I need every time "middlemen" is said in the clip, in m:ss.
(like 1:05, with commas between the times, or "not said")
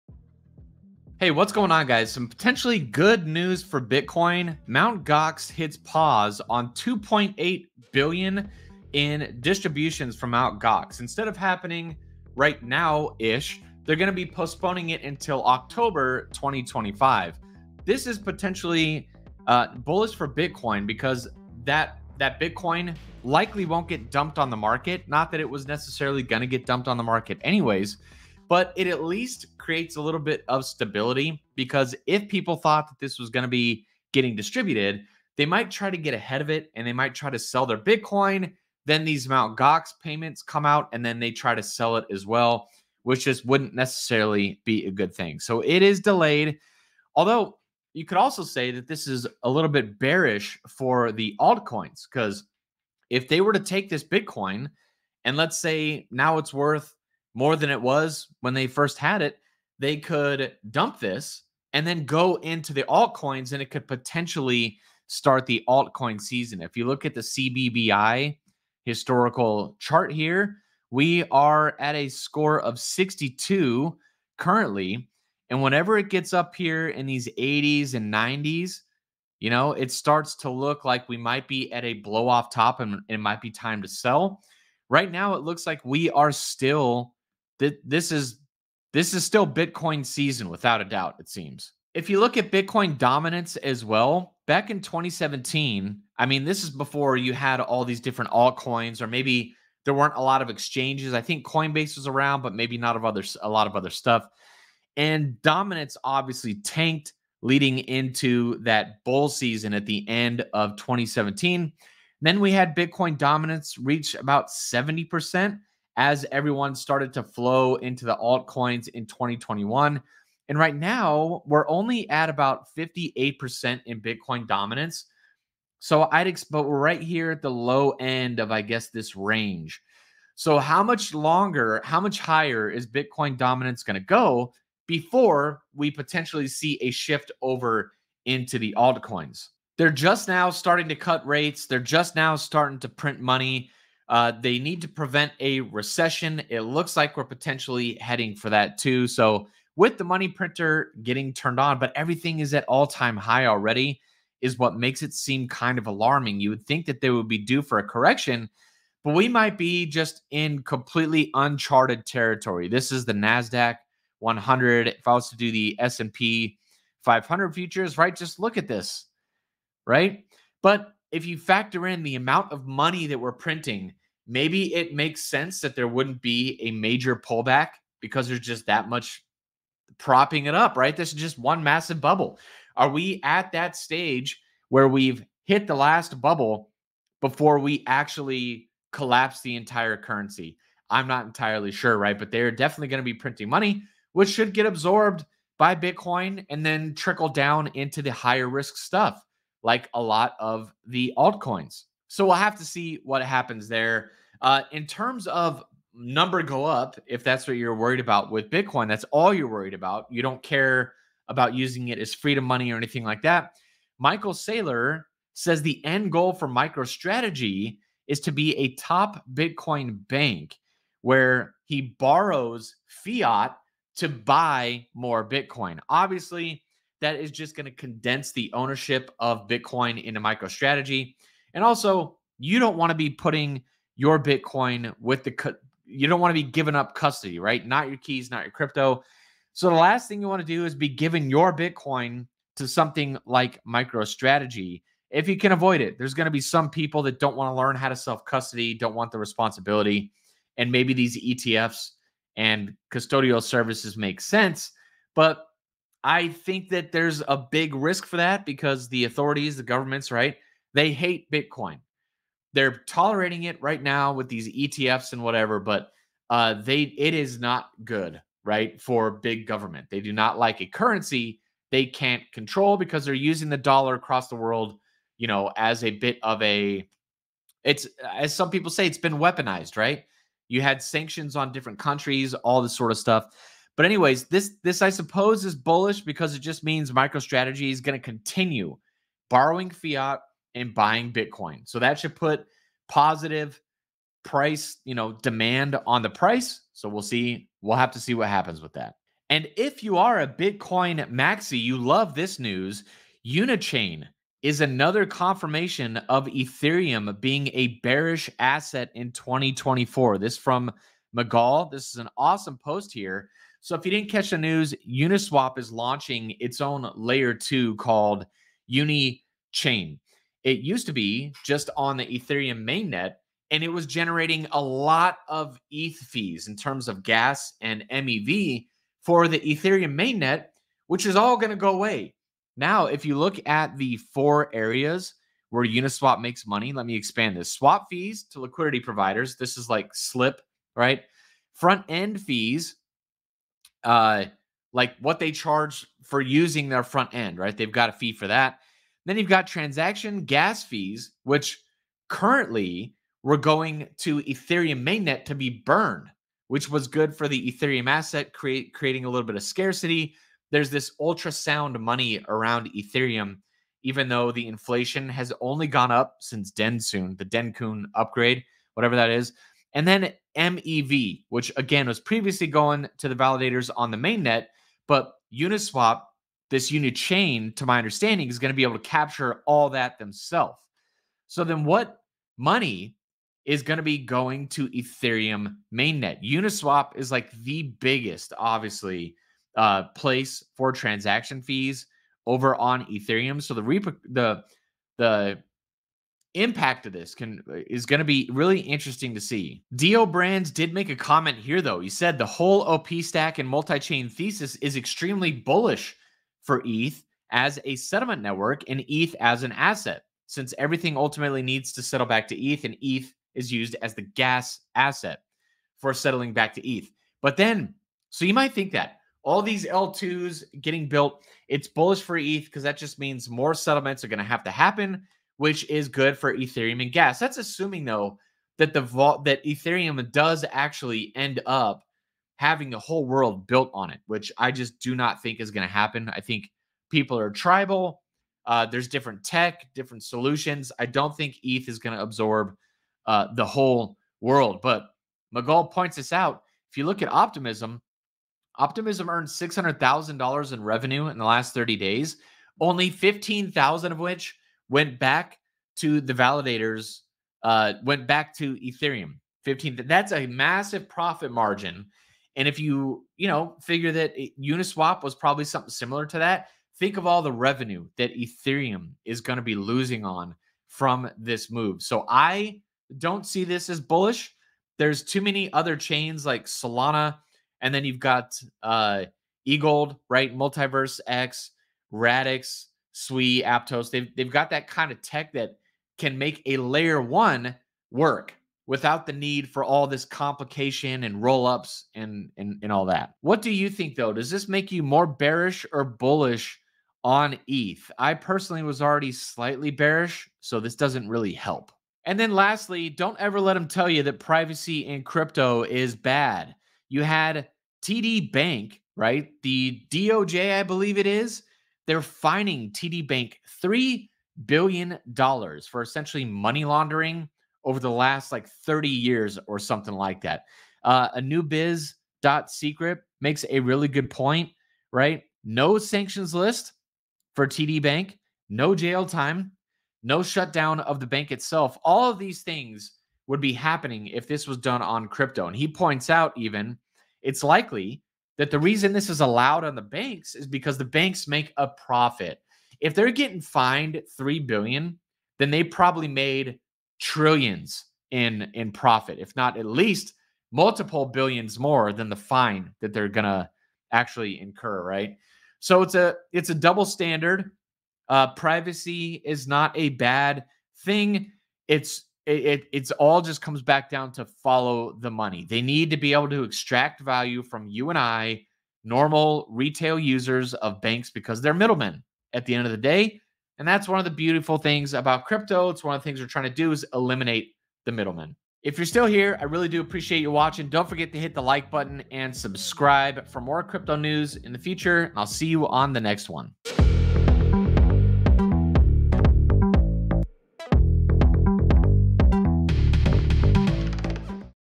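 9:31, 9:37.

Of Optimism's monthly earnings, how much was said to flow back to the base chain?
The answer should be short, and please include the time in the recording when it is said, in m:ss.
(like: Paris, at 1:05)
15,000, at 7:32.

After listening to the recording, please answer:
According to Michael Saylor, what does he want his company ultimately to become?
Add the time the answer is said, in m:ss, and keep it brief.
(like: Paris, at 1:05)
top Bitcoin bank, at 3:38.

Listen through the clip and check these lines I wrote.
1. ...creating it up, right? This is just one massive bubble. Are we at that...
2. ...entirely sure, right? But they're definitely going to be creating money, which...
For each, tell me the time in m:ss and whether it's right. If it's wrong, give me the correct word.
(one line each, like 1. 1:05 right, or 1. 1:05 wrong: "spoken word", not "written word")
1. 2:59 wrong: "propping", not "creating"
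2. 3:11 wrong: "printing", not "creating".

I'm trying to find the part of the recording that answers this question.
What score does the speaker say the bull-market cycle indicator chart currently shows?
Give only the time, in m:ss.
1:12.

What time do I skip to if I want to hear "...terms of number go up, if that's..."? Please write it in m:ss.
3:24.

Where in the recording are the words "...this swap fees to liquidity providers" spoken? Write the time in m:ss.
5:37.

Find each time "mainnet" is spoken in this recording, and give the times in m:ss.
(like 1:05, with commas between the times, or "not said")
5:22, 5:29, 5:54, 6:13, 6:25.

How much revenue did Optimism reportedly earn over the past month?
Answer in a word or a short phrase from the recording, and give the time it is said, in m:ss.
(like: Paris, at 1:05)
$600,000, at 7:29.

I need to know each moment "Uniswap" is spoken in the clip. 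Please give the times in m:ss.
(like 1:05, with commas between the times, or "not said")
5:14, 5:35, 6:15, 6:26, 7:44.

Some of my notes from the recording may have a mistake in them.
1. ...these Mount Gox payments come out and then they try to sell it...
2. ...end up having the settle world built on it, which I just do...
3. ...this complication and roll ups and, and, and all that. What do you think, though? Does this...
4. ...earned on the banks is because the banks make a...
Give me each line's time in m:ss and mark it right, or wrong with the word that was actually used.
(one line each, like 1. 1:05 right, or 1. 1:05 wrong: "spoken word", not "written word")
1. 0:39 right
2. 7:11 wrong: "whole", not "settle"
3. 8:09 right
4. 8:59 wrong: "allowed", not "earned".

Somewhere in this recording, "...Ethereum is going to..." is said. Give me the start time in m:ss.
7:48.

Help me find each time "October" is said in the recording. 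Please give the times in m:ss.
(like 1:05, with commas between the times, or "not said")
0:15.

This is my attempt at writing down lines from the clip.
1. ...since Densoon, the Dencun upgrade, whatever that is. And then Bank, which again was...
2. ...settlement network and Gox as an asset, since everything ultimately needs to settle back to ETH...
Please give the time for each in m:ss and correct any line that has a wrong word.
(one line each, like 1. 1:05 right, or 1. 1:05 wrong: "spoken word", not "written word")
1. 6:06 wrong: "MEV", not "Bank"
2. 6:47 wrong: "ETH", not "Gox".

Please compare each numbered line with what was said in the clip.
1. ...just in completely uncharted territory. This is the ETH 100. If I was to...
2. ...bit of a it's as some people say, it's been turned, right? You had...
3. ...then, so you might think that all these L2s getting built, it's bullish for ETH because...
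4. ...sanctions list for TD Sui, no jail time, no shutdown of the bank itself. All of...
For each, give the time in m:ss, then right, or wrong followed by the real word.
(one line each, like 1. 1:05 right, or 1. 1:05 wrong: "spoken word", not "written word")
1. 2:39 wrong: "NASDAQ", not "ETH"
2. 4:35 wrong: "weaponized", not "turned"
3. 6:57 right
4. 8:45 wrong: "Bank", not "Sui".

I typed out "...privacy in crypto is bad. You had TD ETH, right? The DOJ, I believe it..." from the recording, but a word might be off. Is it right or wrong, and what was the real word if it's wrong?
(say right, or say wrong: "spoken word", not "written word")
wrong: "Bank", not "ETH".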